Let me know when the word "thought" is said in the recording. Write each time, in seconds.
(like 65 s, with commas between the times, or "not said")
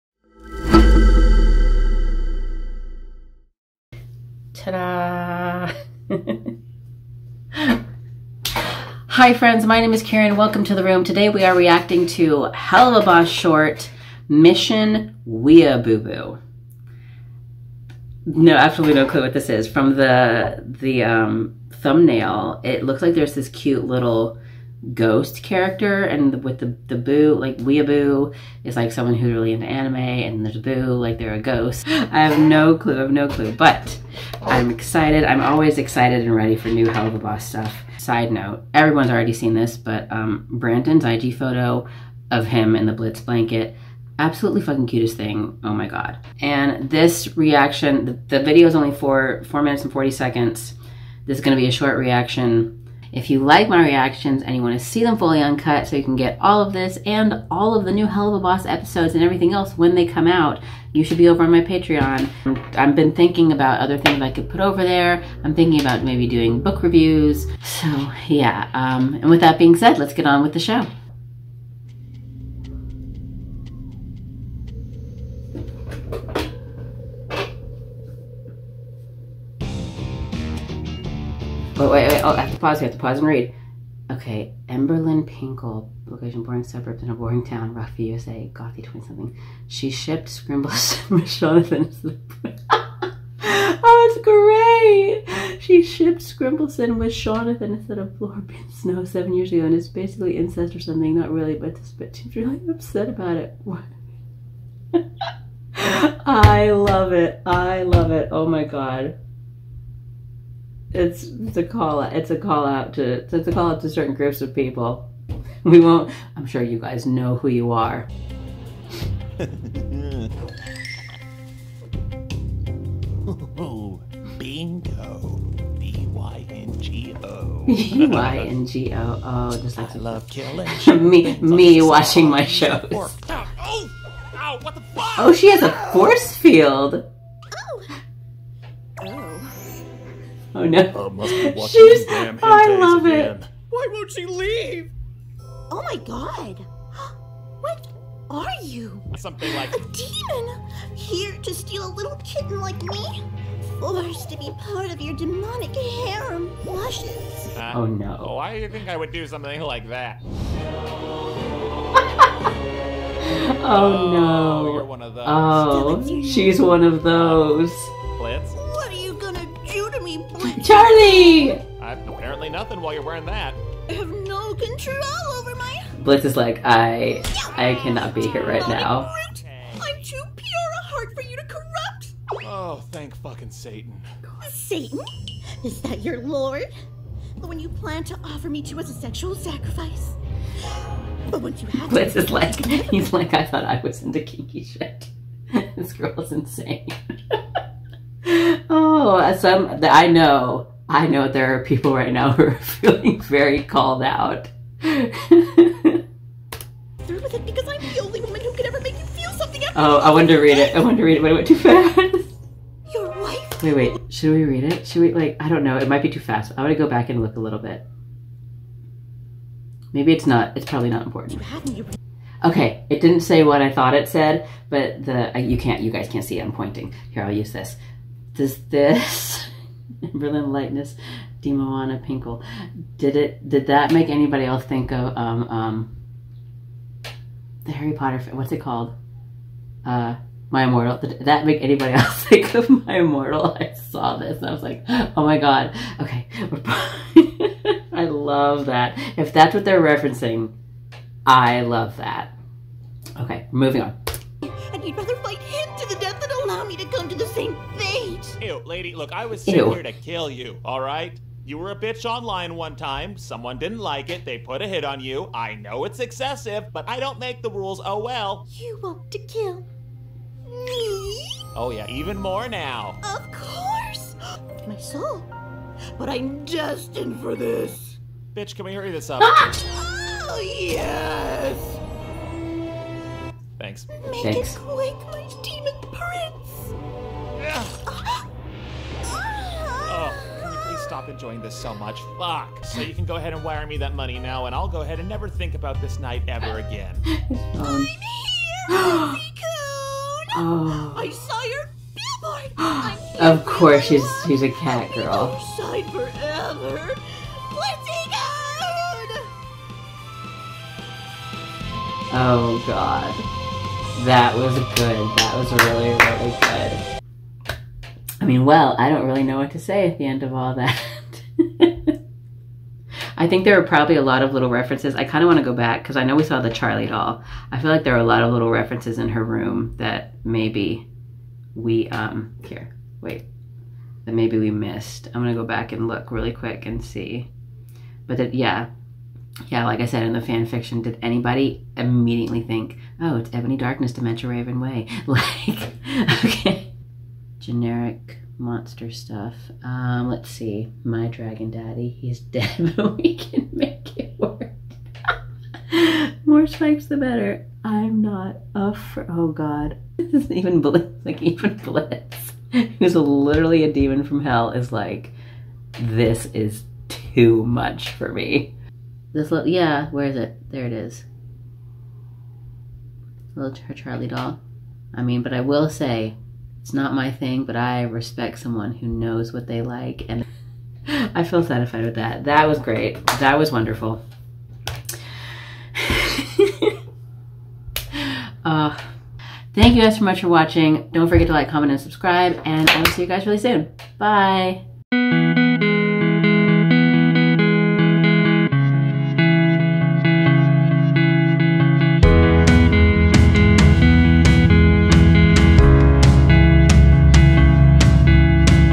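193 s, 223 s.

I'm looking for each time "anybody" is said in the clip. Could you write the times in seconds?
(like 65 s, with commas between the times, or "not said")
234 s, 241 s, 341 s.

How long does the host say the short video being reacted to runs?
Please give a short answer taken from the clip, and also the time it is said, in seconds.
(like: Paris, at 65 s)
4 minutes 40 seconds, at 49 s.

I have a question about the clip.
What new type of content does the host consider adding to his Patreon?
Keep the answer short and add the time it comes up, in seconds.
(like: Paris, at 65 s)
Book reviews, at 66 s.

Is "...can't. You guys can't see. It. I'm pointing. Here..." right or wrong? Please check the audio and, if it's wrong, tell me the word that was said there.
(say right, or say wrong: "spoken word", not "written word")
right.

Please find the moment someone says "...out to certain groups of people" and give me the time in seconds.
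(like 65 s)
113 s.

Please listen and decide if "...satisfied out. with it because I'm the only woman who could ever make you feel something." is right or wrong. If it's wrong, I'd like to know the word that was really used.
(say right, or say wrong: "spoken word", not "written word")
wrong: "called", not "satisfied".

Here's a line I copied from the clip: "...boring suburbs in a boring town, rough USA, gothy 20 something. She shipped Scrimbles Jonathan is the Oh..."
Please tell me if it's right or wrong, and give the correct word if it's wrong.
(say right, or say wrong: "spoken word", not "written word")
right.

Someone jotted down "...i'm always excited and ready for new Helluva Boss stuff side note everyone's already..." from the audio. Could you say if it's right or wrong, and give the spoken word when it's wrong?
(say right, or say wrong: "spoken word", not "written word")
right.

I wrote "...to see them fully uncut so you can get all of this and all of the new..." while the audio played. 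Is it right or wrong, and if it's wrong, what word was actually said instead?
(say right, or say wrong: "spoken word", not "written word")
right.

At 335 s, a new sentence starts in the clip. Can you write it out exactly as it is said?
I'm going to go back and look really quick and see.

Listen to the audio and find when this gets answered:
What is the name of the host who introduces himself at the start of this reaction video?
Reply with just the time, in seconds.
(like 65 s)
10 s.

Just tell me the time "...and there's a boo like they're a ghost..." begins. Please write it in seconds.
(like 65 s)
29 s.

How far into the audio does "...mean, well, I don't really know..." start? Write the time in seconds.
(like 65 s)
318 s.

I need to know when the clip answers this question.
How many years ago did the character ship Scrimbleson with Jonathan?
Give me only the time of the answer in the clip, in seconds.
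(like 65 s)
99 s.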